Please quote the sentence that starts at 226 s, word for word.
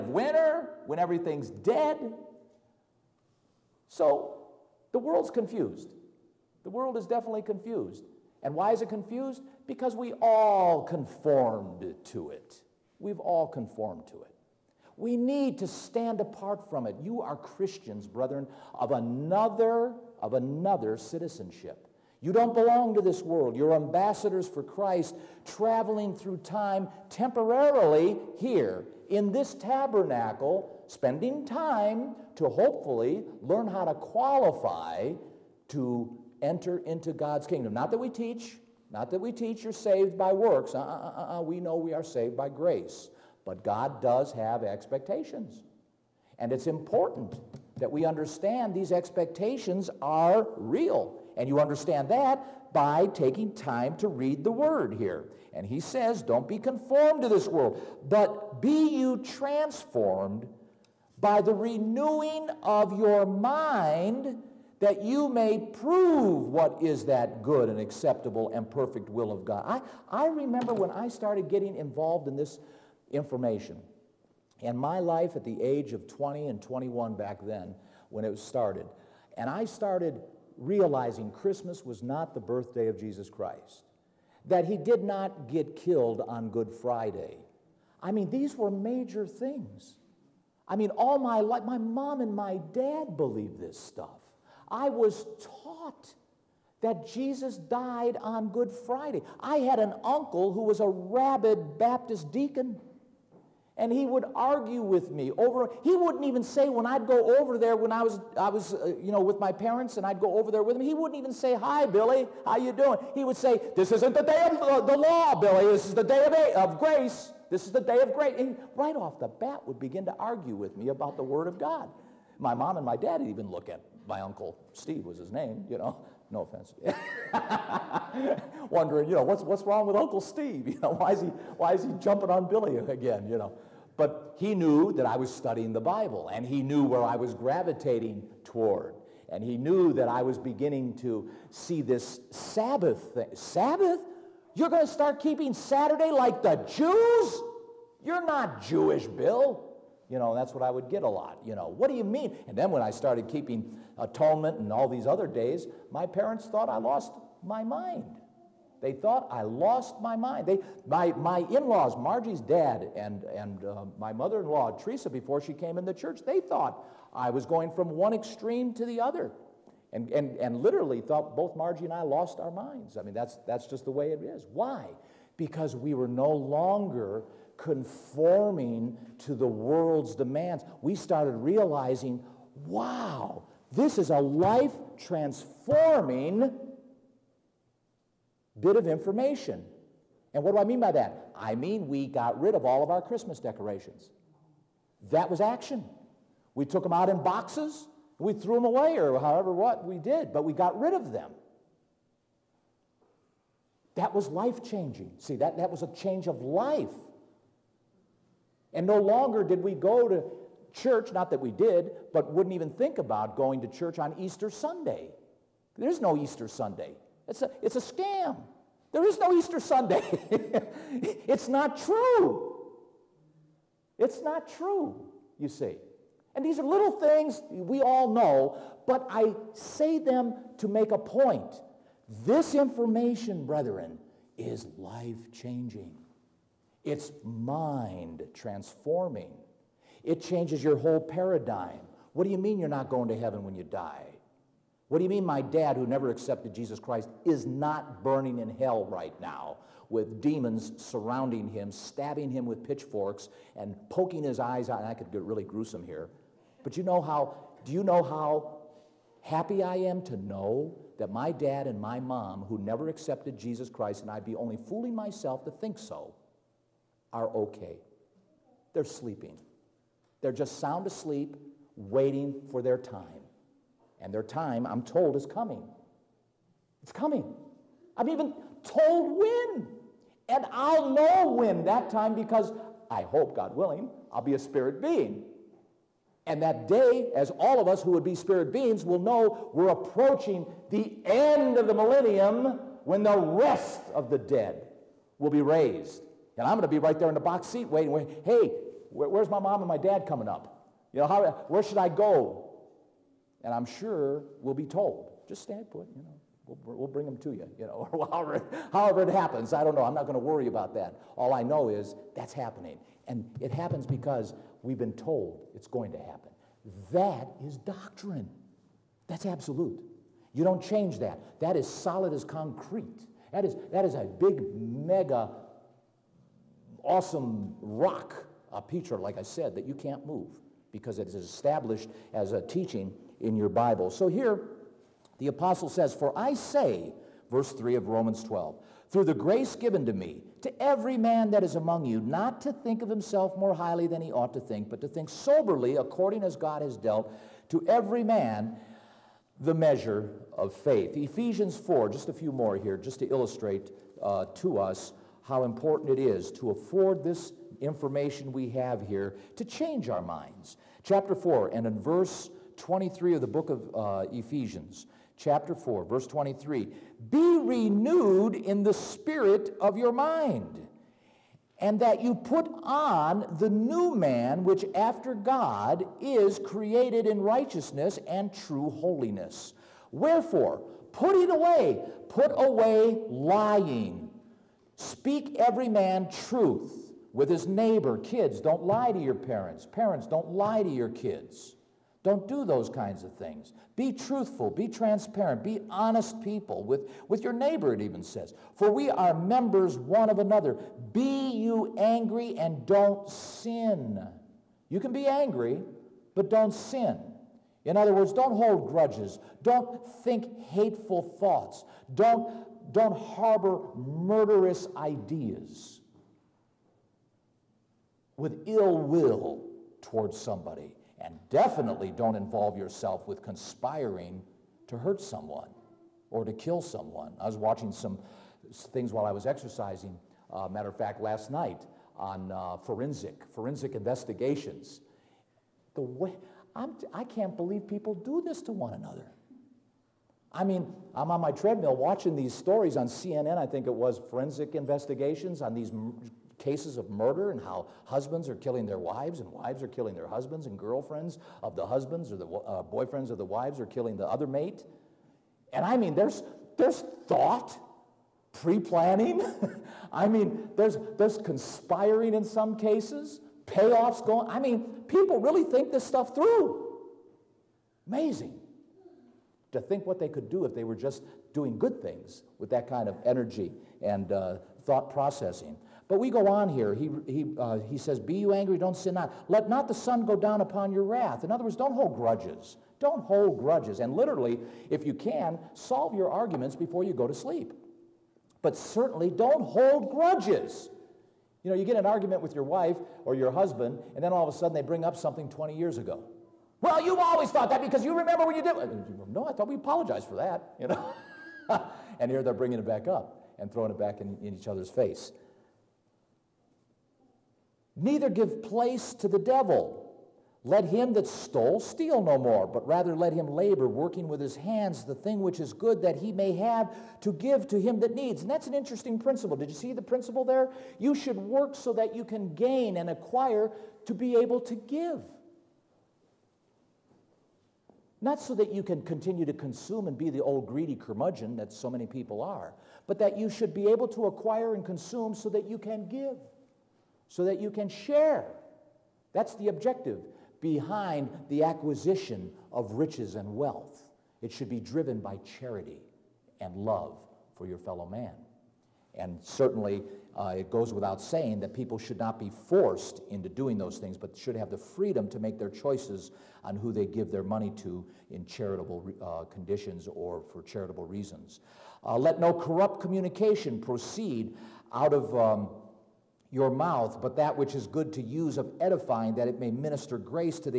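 And these are little things we all know, but I say them to make a point.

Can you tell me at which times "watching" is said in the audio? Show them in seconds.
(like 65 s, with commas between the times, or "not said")
427 s, 441 s.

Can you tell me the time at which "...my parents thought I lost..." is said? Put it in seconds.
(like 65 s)
155 s.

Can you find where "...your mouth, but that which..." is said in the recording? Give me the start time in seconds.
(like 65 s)
566 s.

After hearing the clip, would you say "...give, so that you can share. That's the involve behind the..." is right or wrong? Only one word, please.
wrong.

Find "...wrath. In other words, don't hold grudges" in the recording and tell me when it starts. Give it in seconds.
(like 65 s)
480 s.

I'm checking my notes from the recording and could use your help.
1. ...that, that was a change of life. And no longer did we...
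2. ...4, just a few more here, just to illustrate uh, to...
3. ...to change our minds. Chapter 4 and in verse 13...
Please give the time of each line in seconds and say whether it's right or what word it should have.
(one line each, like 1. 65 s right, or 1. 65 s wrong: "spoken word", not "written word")
1. 205 s right
2. 351 s right
3. 359 s wrong: "23", not "13".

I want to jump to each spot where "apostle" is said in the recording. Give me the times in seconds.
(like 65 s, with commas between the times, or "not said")
335 s.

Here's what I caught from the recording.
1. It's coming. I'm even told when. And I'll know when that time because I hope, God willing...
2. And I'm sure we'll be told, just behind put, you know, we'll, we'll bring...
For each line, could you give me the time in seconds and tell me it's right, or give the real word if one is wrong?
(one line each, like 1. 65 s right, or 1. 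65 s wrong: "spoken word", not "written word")
1. 276 s right
2. 303 s wrong: "stand", not "behind".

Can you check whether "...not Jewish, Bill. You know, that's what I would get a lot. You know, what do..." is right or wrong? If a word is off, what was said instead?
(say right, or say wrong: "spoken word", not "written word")
right.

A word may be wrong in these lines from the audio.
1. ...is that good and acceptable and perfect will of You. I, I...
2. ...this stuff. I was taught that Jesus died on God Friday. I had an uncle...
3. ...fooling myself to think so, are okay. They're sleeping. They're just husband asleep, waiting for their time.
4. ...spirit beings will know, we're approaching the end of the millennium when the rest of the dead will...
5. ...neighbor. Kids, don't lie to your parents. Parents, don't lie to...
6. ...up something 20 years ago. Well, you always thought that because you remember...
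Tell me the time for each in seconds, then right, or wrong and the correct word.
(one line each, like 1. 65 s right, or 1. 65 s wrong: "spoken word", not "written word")
1. 66 s wrong: "God", not "You"
2. 93 s wrong: "Good", not "God"
3. 264 s wrong: "sound", not "husband"
4. 288 s right
5. 387 s right
6. 494 s right.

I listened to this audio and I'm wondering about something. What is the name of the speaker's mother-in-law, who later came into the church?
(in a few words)
Teresa.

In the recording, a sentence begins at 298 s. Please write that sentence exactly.
hey, where's my mom and my dad coming up?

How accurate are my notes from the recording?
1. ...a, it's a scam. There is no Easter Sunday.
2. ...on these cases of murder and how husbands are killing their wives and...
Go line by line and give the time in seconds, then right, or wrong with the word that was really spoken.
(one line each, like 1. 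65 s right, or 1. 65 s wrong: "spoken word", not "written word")
1. 217 s right
2. 445 s right.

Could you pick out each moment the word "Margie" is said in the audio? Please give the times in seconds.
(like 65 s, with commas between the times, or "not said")
161 s, 171 s.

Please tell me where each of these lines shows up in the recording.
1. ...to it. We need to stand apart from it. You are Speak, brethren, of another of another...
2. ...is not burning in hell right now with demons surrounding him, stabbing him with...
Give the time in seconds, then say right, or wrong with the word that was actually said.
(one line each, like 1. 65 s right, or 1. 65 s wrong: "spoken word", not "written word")
1. 14 s wrong: "Christians", not "Speak"
2. 247 s right.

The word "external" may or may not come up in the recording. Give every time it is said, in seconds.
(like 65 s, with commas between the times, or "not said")
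not said.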